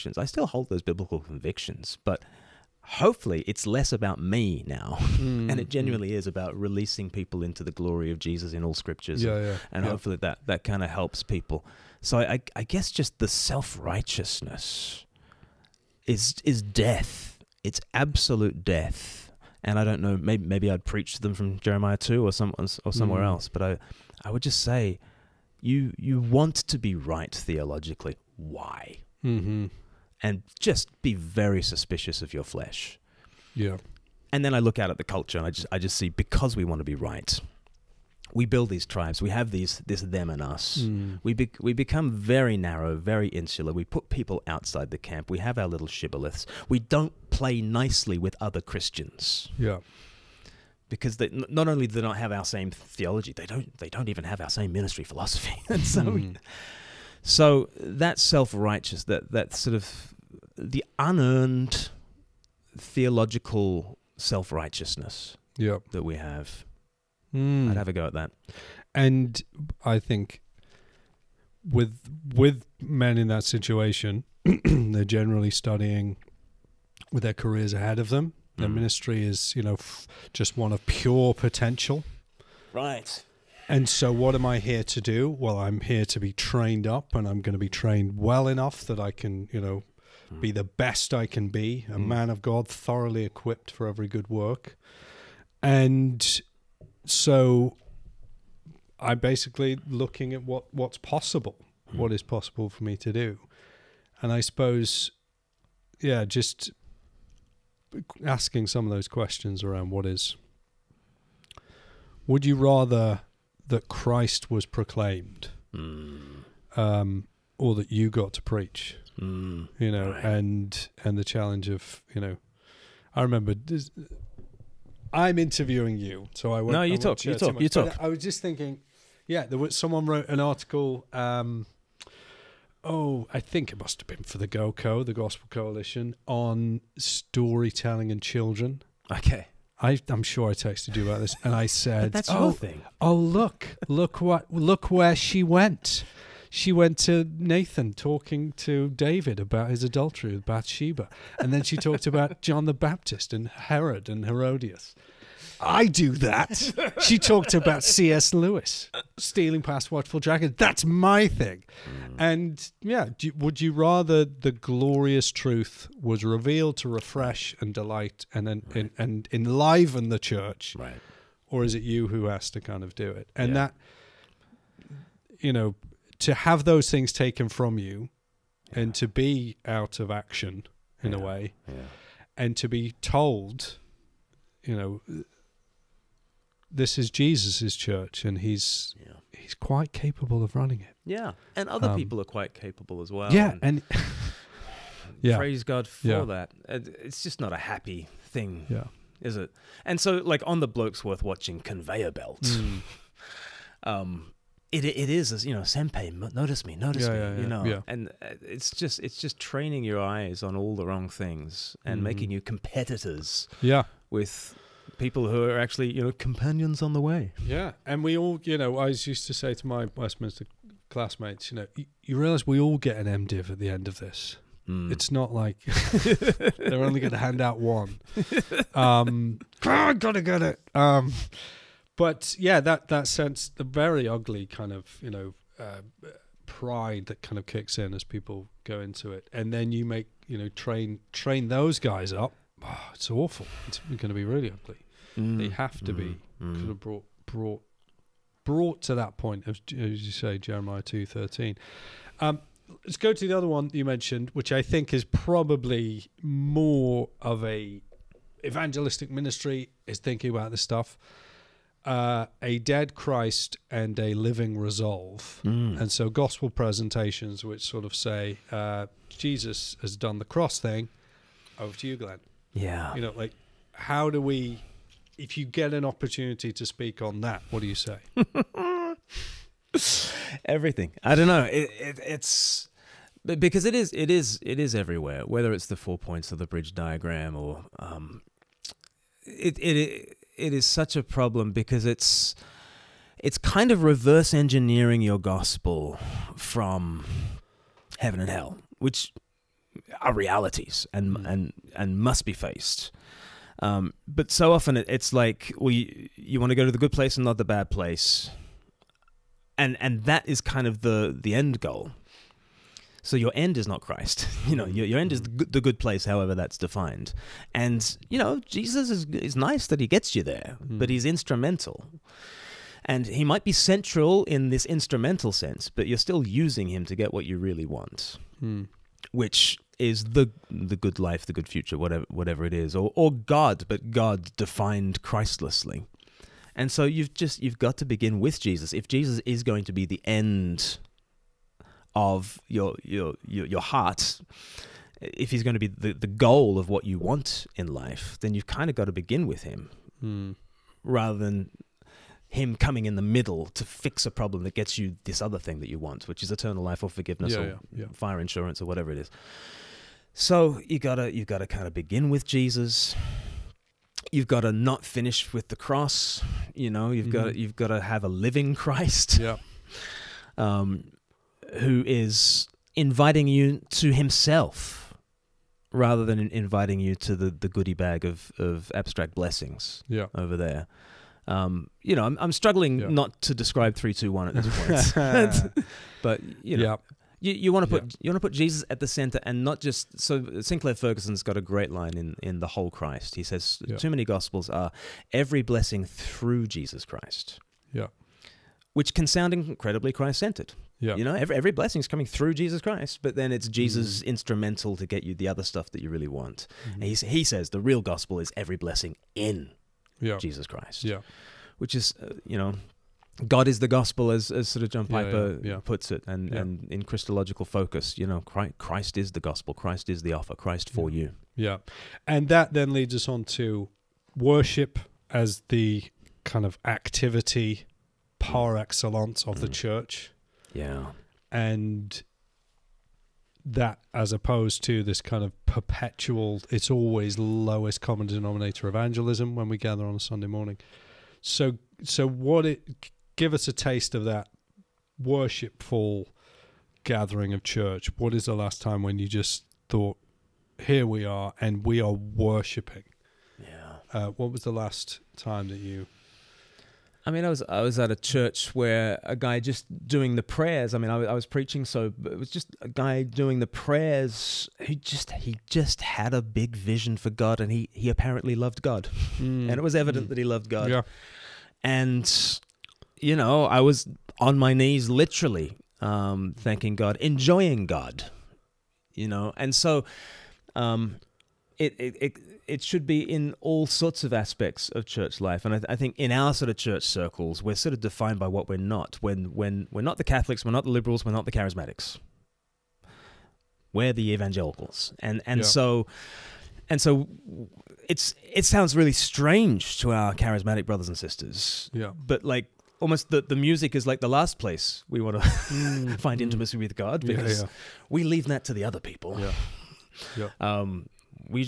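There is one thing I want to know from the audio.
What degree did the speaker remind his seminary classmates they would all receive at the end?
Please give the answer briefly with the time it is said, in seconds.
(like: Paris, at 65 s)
MDiv, at 223 s.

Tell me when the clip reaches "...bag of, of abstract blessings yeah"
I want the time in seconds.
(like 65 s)
377 s.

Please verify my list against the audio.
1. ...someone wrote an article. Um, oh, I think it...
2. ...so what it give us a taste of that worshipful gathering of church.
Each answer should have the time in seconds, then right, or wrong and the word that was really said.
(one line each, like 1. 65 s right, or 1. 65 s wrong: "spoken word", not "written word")
1. 129 s right
2. 441 s right.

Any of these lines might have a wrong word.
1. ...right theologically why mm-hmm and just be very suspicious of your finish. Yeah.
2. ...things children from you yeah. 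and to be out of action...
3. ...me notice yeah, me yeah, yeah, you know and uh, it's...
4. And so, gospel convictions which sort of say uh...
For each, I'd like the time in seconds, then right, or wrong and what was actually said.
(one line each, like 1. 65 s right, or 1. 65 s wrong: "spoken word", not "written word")
1. 26 s wrong: "flesh", not "finish"
2. 176 s wrong: "taken", not "children"
3. 206 s right
4. 265 s wrong: "presentations", not "convictions".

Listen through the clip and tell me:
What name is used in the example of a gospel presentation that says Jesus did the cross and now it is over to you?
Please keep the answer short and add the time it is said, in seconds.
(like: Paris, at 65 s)
Glen, at 271 s.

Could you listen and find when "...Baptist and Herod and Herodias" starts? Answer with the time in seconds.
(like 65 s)
152 s.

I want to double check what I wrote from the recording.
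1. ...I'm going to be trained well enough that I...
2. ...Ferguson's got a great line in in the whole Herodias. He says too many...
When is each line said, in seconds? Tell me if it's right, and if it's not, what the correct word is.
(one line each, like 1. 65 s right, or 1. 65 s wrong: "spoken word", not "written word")
1. 87 s right
2. 390 s wrong: "Christ", not "Herodias".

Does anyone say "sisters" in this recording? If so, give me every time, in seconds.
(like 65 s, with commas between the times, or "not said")
500 s.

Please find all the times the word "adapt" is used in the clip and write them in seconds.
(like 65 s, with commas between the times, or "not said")
not said.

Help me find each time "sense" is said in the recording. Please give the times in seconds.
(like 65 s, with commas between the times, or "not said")
233 s, 325 s.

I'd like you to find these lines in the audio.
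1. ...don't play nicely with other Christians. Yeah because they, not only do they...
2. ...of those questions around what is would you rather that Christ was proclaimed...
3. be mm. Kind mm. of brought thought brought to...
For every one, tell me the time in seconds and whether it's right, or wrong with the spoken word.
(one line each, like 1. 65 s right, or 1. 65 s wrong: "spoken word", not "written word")
1. 46 s right
2. 108 s right
3. 245 s wrong: "brought", not "thought".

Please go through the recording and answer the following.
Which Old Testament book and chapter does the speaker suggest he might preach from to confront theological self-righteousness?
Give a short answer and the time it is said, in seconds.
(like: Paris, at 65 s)
Jeremiah 2, at 21 s.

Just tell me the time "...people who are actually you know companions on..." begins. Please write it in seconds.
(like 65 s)
214 s.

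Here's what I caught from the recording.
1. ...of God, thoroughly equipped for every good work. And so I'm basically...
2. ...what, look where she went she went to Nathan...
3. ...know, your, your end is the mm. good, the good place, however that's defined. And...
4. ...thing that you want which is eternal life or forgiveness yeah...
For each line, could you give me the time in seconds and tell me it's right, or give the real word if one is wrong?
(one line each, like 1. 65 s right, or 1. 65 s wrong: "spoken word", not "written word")
1. 92 s right
2. 144 s right
3. 314 s right
4. 355 s right.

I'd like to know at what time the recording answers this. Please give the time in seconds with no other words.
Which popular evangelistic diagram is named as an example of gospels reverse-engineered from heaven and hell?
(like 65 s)
286 s.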